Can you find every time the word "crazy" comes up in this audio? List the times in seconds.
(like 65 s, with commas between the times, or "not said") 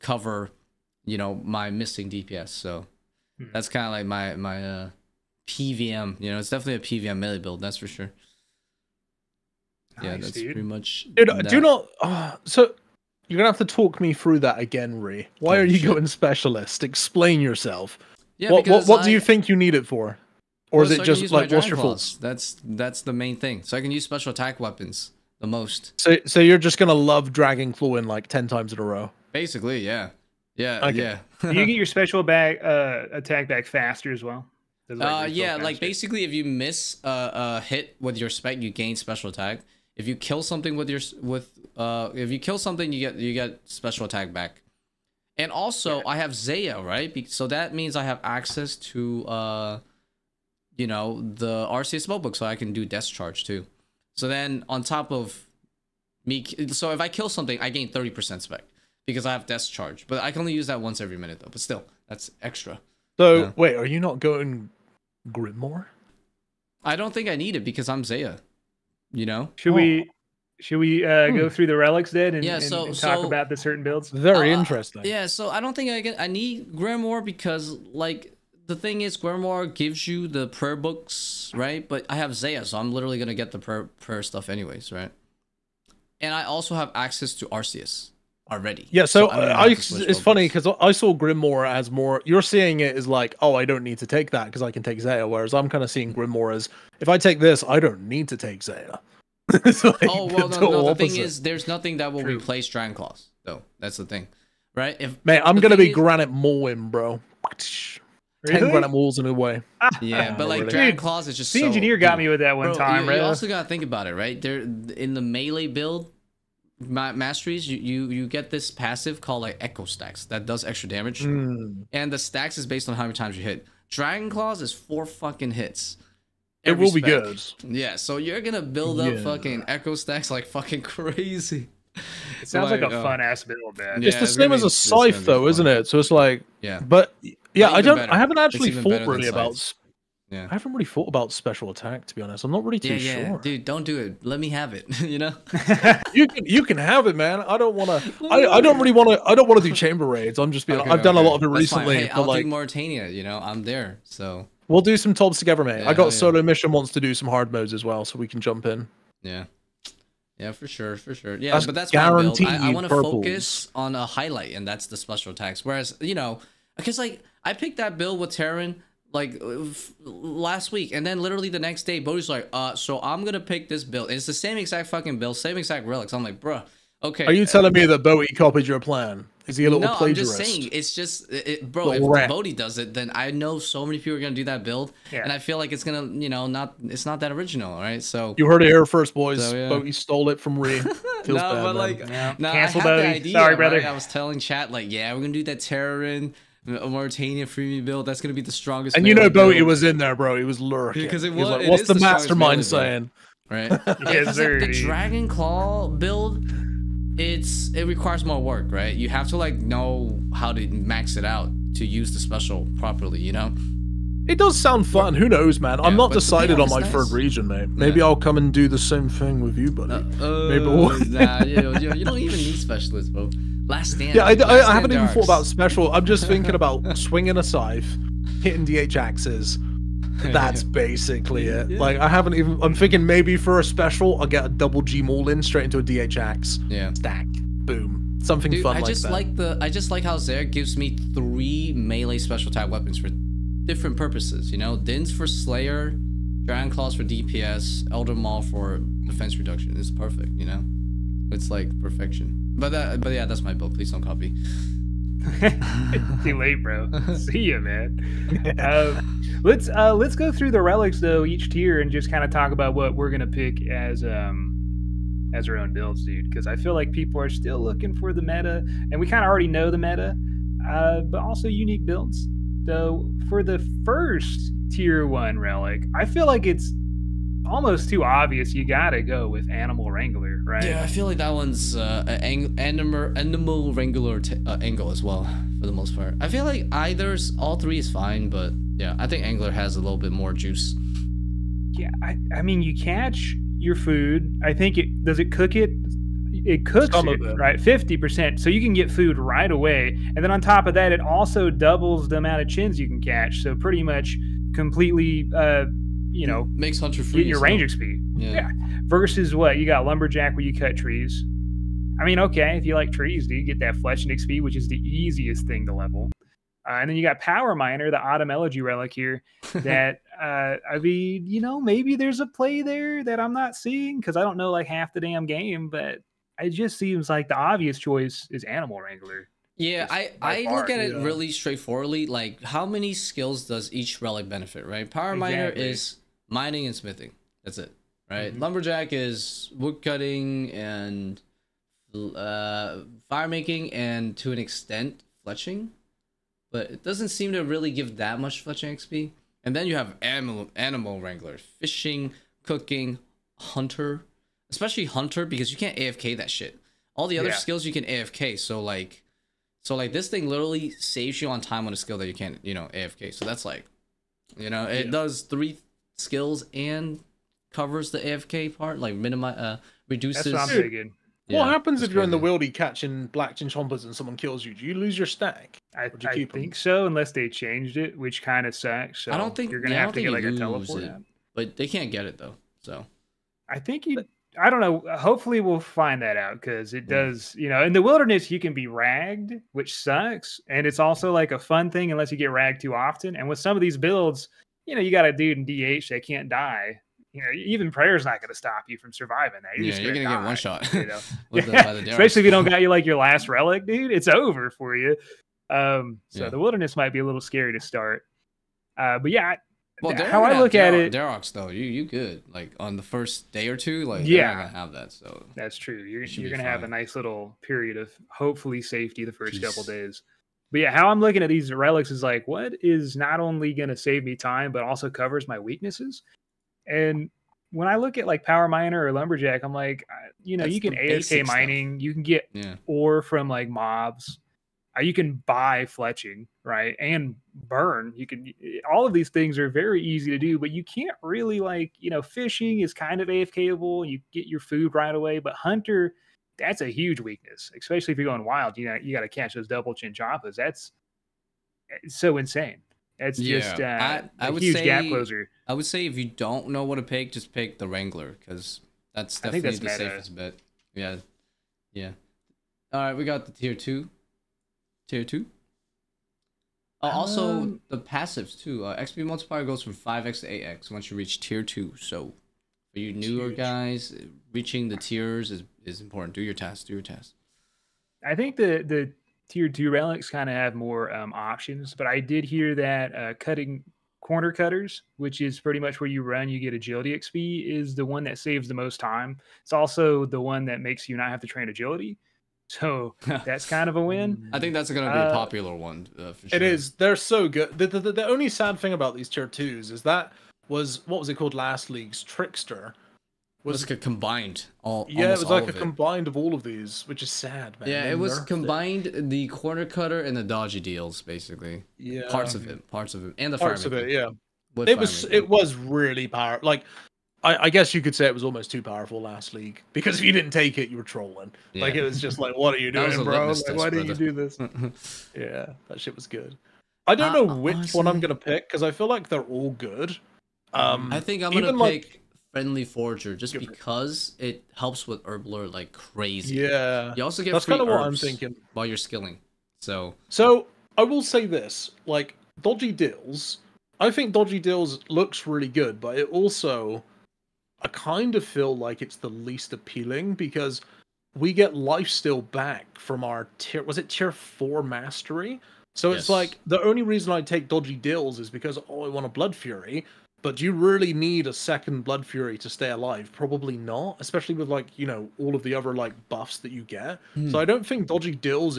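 130 s, 535 s.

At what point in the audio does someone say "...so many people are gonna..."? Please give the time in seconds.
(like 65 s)
183 s.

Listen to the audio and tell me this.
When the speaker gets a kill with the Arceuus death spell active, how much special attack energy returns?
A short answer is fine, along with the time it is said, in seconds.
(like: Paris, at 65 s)
30%, at 57 s.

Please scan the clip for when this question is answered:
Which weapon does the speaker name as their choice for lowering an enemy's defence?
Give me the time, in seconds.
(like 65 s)
247 s.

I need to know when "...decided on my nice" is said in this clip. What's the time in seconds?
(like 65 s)
216 s.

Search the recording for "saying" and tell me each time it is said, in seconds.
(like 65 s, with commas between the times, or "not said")
180 s, 202 s.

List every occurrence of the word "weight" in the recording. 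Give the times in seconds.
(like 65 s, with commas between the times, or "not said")
not said.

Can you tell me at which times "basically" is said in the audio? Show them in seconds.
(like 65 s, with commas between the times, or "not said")
29 s, 35 s, 230 s, 511 s.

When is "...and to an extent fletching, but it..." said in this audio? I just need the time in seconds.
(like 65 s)
343 s.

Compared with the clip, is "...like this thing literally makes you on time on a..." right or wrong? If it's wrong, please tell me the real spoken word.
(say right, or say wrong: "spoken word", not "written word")
wrong: "saves", not "makes".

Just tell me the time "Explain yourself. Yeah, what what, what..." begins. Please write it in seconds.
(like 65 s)
16 s.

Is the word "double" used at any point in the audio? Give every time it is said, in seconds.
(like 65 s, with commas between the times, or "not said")
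234 s, 301 s, 449 s.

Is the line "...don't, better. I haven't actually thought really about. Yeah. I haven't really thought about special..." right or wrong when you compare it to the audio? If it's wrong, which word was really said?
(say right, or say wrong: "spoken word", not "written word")
right.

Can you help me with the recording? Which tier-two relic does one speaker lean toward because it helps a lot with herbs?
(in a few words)
Friendly Forager.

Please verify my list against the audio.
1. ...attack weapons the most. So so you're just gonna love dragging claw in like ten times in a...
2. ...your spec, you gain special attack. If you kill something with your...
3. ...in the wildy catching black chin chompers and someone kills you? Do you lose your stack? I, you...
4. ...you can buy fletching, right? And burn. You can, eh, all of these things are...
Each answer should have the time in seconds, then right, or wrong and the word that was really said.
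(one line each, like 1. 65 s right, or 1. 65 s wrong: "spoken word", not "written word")
1. 24 s right
2. 38 s right
3. 372 s right
4. 434 s right.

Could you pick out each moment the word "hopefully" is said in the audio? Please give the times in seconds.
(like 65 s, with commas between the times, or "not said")
384 s, 418 s.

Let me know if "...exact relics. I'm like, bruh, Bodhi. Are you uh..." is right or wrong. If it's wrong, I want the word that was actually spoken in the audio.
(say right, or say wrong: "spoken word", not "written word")
wrong: "Okay", not "Bodhi".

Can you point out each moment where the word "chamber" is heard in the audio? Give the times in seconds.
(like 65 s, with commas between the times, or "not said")
149 s.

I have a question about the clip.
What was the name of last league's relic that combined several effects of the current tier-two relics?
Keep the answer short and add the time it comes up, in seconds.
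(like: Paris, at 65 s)
Trickster, at 502 s.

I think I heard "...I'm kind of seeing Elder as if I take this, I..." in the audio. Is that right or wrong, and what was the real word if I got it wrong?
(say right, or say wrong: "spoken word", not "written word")
wrong: "Grimoire", not "Elder".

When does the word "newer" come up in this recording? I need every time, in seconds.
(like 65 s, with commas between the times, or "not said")
472 s.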